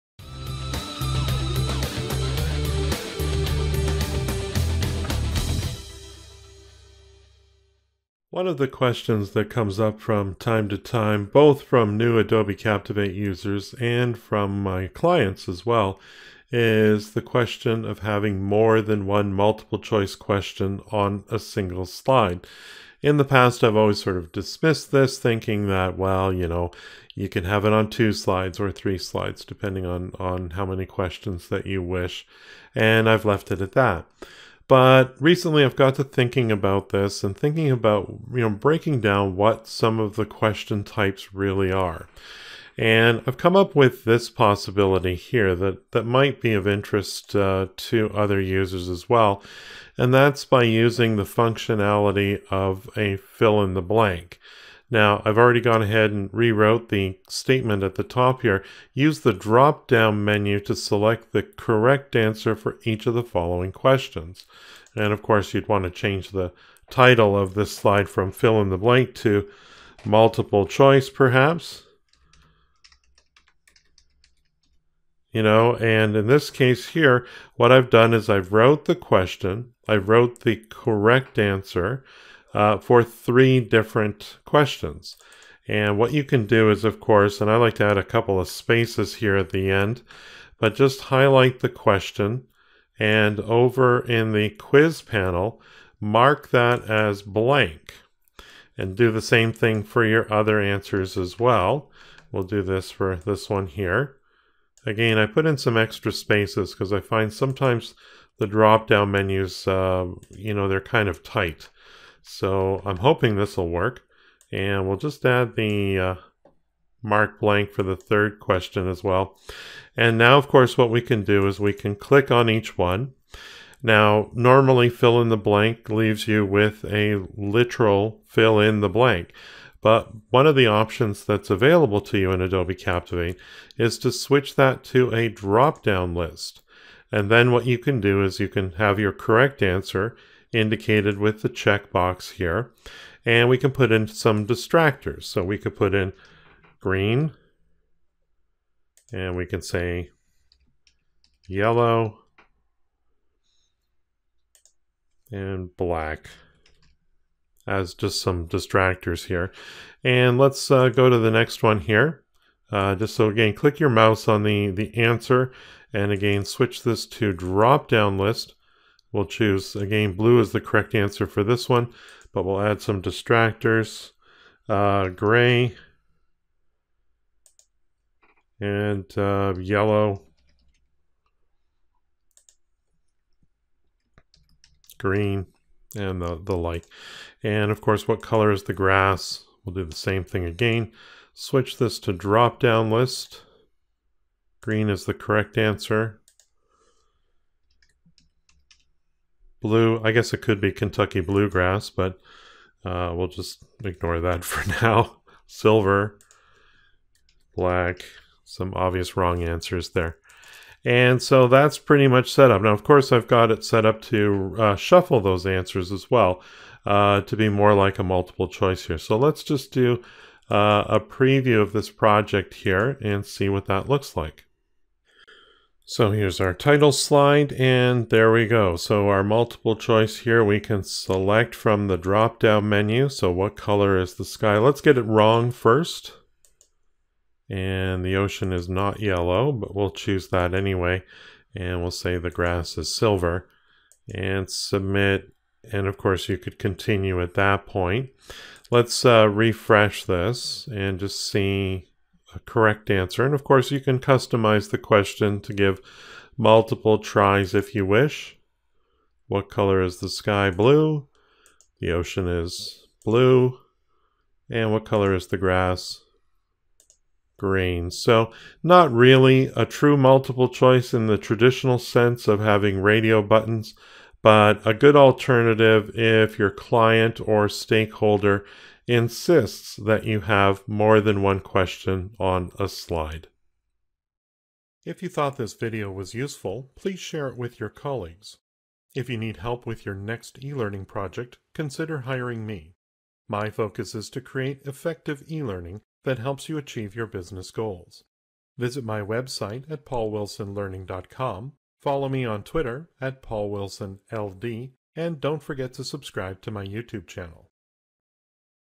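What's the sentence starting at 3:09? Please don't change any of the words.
We'll do the same thing again.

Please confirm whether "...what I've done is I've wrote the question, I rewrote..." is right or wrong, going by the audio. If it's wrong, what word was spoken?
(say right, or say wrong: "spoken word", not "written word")
wrong: "wrote", not "rewrote".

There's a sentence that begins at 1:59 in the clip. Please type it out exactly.
And now, of course, what we can do is we can click on each one.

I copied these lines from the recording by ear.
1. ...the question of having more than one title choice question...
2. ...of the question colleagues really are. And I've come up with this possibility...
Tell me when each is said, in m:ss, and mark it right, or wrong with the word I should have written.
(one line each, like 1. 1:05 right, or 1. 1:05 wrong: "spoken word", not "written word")
1. 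0:17 wrong: "multiple", not "title"
2. 0:39 wrong: "types", not "colleagues".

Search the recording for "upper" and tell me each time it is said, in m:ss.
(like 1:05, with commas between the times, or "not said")
not said.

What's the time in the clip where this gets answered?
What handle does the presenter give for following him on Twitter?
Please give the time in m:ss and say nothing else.
5:03.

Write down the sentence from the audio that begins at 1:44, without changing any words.
Again, I put in some extra spaces because I find sometimes the drop-down menus, uh, you know, they're kind of tight.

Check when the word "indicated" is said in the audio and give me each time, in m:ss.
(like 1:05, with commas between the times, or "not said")
2:20.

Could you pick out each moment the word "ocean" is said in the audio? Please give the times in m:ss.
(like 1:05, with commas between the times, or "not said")
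3:58, 4:21.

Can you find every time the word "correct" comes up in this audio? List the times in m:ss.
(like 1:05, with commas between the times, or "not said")
1:01, 1:20, 2:19, 2:50, 3:15, 4:12.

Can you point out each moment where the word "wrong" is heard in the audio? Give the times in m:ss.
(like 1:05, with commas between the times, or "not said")
3:29, 3:55.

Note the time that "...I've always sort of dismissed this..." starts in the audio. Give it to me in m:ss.
0:23.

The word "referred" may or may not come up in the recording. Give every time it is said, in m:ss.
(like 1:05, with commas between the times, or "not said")
not said.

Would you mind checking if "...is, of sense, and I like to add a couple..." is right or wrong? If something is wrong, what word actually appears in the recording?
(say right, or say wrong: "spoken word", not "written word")
wrong: "course", not "sense".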